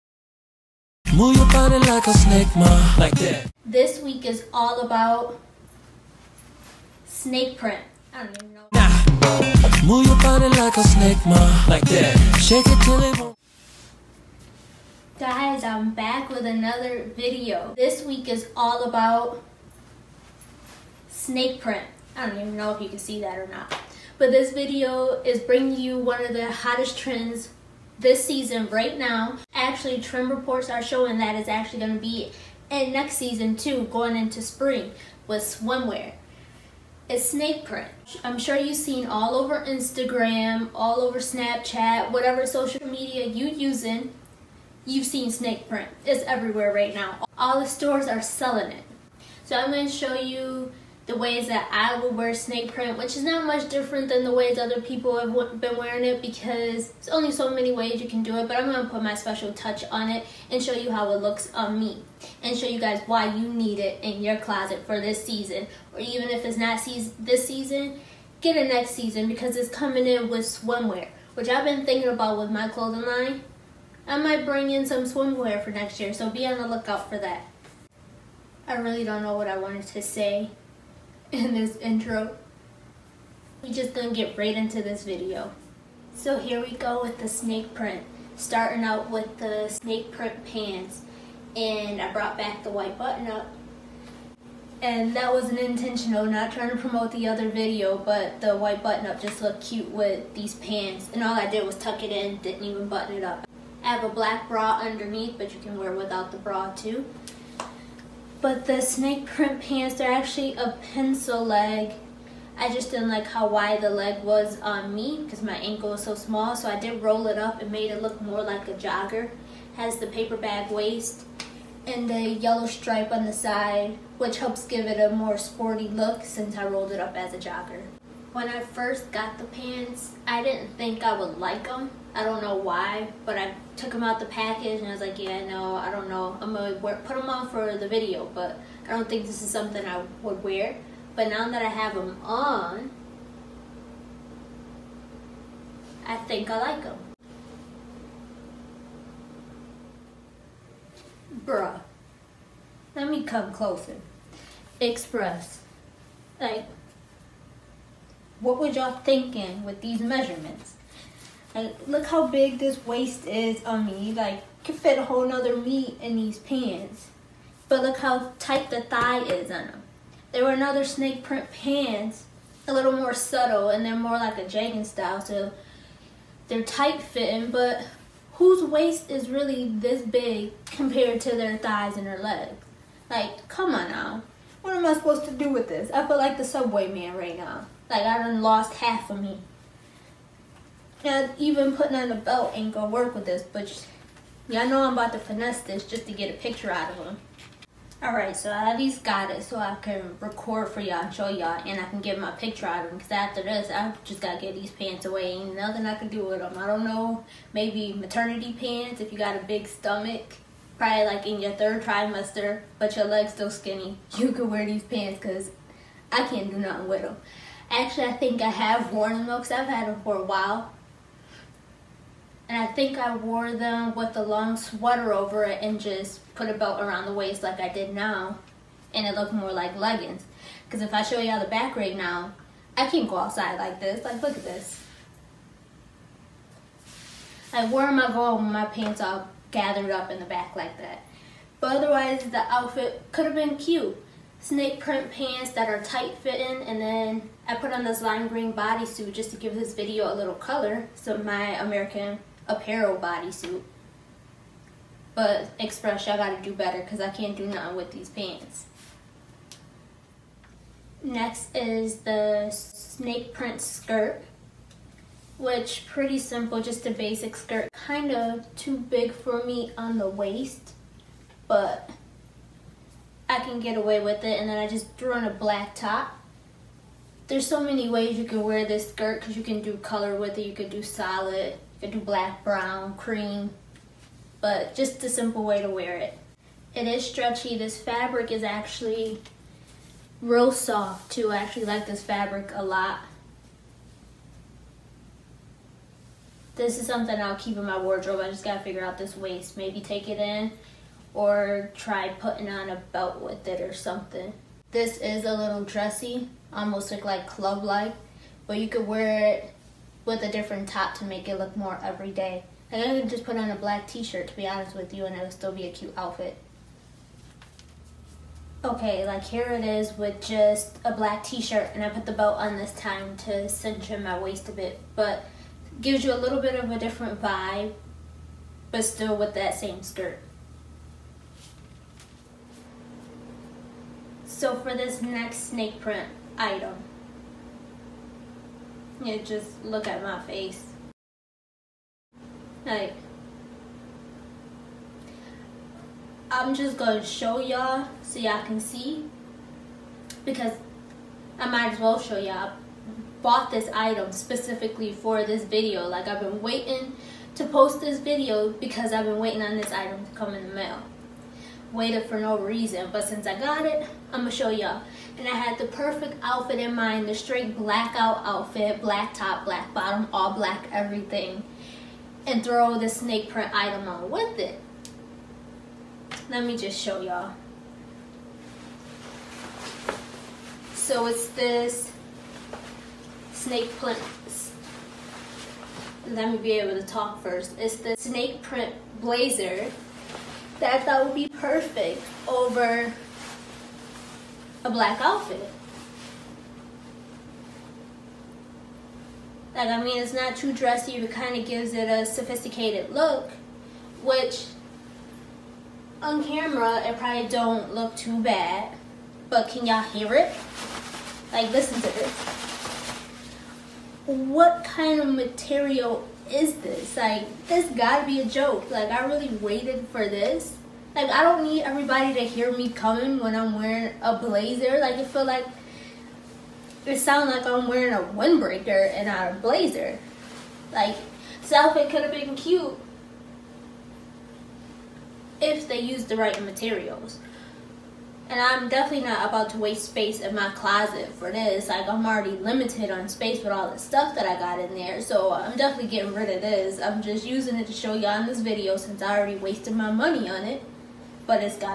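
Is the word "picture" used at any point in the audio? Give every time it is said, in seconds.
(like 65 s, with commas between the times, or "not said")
196 s, 202 s.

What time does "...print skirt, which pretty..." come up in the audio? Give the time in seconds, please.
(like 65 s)
263 s.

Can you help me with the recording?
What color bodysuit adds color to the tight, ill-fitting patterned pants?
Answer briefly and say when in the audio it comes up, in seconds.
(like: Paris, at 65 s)
Lime green, at 248 s.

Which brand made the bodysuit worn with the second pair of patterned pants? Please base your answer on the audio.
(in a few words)
American Apparel.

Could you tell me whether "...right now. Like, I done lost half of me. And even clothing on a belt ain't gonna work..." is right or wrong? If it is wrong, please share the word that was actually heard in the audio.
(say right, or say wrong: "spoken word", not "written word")
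wrong: "putting", not "clothing".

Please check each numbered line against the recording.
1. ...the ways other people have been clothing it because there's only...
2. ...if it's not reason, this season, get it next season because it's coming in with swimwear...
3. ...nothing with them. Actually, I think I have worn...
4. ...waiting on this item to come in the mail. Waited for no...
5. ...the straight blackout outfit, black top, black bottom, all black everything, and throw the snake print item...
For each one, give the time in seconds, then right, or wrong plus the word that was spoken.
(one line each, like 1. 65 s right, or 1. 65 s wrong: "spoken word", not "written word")
1. 54 s wrong: "wearing", not "clothing"
2. 66 s wrong: "season", not "reason"
3. 216 s right
4. 359 s right
5. 367 s right.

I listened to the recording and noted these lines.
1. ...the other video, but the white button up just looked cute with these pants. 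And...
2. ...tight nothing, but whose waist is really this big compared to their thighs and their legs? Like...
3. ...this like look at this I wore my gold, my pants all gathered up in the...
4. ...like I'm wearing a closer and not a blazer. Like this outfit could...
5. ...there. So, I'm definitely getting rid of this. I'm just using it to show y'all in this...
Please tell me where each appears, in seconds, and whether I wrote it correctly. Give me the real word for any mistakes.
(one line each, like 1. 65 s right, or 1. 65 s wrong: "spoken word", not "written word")
1. 97 s right
2. 176 s wrong: "fitting", not "nothing"
3. 233 s right
4. 427 s wrong: "windbreaker", not "closer"
5. 444 s right.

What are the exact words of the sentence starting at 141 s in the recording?
But now that I have them on, I think I like them.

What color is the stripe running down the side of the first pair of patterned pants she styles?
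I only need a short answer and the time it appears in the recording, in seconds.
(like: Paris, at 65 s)
Yellow, at 122 s.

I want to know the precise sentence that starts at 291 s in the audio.
I actually like this fabric a lot.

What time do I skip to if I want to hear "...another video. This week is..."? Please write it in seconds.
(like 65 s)
16 s.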